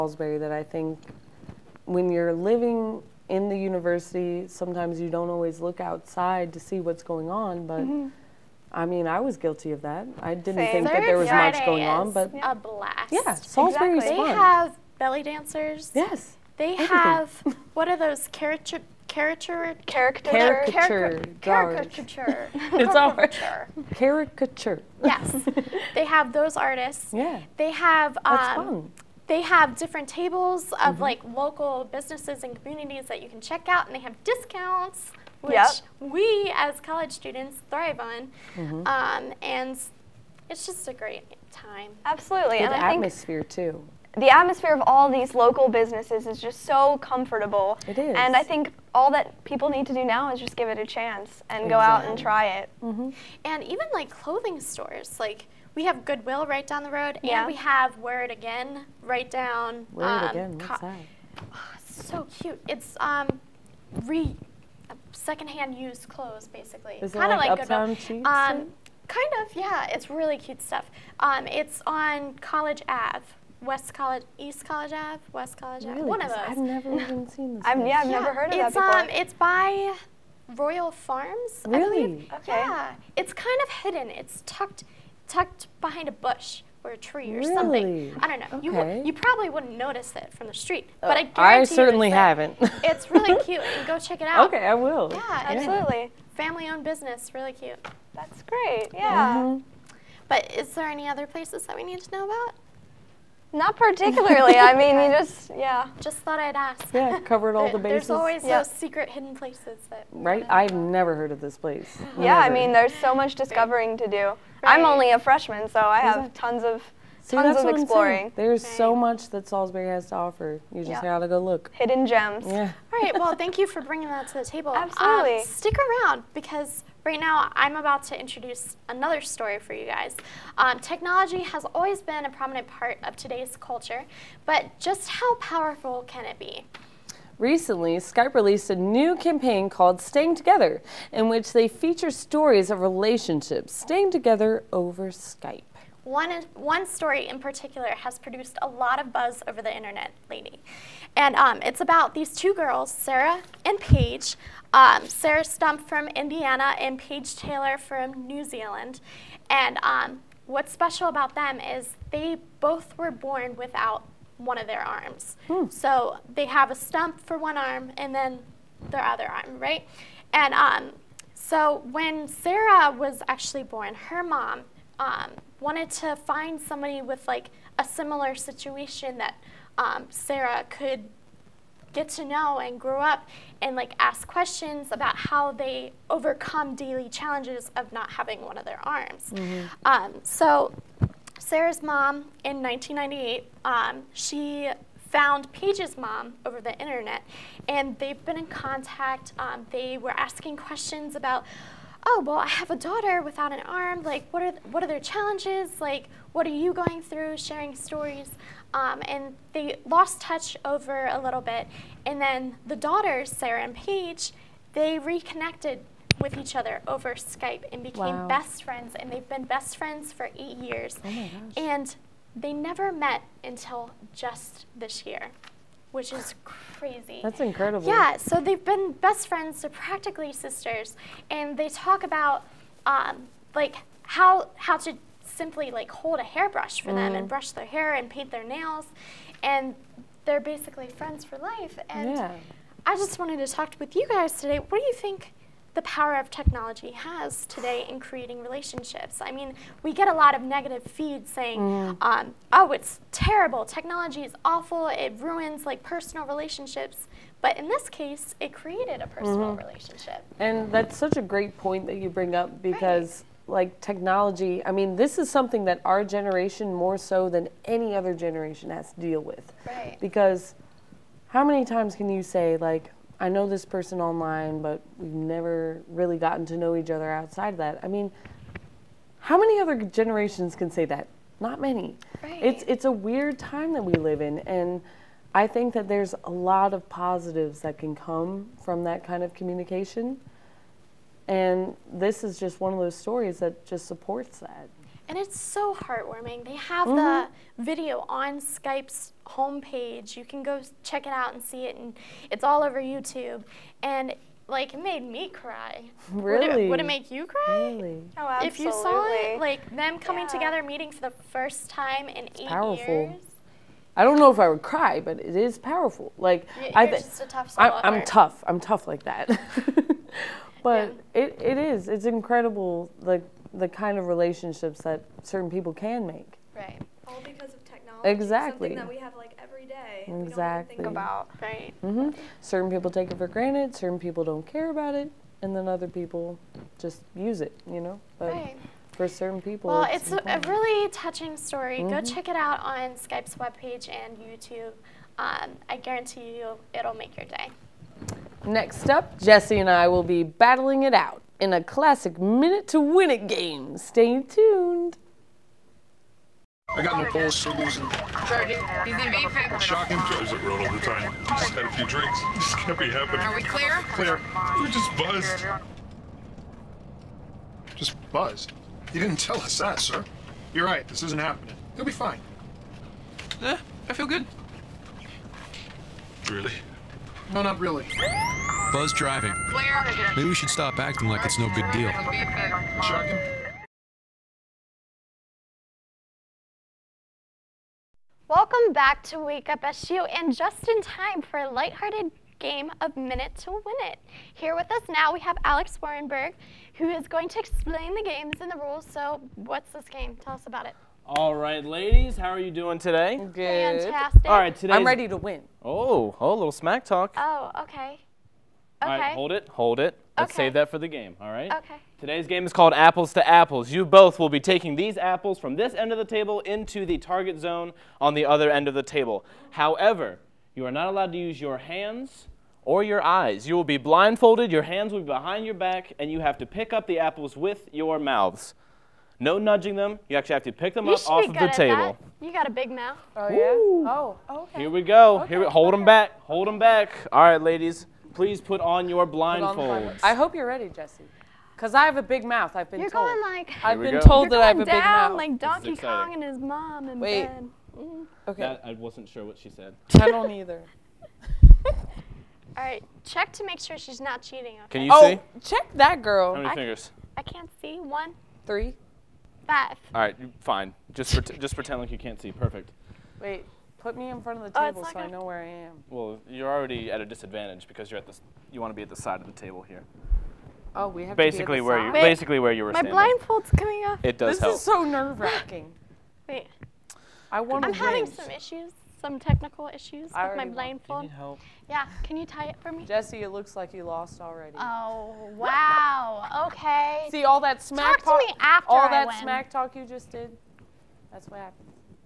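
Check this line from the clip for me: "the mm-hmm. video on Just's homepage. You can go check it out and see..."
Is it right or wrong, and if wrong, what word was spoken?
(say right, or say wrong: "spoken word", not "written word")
wrong: "Skype", not "Just".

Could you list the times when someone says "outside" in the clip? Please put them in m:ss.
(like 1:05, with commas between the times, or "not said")
0:05, 4:37.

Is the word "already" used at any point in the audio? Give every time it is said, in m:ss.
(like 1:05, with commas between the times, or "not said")
7:46, 8:04.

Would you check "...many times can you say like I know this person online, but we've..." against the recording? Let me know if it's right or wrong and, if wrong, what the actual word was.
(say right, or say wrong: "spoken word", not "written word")
right.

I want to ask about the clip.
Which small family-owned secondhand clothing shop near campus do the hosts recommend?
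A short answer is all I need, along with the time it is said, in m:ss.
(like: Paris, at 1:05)
Wear It Again, at 0:58.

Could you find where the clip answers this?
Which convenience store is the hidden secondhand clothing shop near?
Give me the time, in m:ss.
1:20.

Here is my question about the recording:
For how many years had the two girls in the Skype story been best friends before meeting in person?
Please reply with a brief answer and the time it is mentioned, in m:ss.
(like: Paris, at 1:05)
8, at 3:40.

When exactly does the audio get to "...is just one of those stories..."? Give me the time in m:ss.
4:52.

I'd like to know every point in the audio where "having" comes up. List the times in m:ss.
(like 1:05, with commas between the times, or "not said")
3:08, 7:57.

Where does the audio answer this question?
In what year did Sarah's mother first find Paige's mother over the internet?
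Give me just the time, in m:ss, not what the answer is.
3:12.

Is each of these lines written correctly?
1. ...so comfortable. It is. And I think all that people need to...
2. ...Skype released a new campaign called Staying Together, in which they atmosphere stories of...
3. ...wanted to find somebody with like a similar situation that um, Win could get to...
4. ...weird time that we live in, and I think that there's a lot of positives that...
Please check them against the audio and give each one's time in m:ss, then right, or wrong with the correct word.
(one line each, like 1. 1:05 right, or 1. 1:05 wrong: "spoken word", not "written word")
1. 0:46 right
2. 2:17 wrong: "feature", not "atmosphere"
3. 2:55 wrong: "Sarah", not "Win"
4. 4:42 right.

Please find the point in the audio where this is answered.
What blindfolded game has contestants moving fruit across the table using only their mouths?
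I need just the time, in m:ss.
6:52.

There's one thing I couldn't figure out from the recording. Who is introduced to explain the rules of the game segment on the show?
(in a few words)
Alex Warrenberg.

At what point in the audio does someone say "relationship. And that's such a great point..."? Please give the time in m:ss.
4:19.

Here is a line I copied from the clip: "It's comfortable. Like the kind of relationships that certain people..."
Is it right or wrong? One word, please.
wrong.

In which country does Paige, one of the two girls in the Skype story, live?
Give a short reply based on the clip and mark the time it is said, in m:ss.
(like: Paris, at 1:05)
New Zealand, at 2:38.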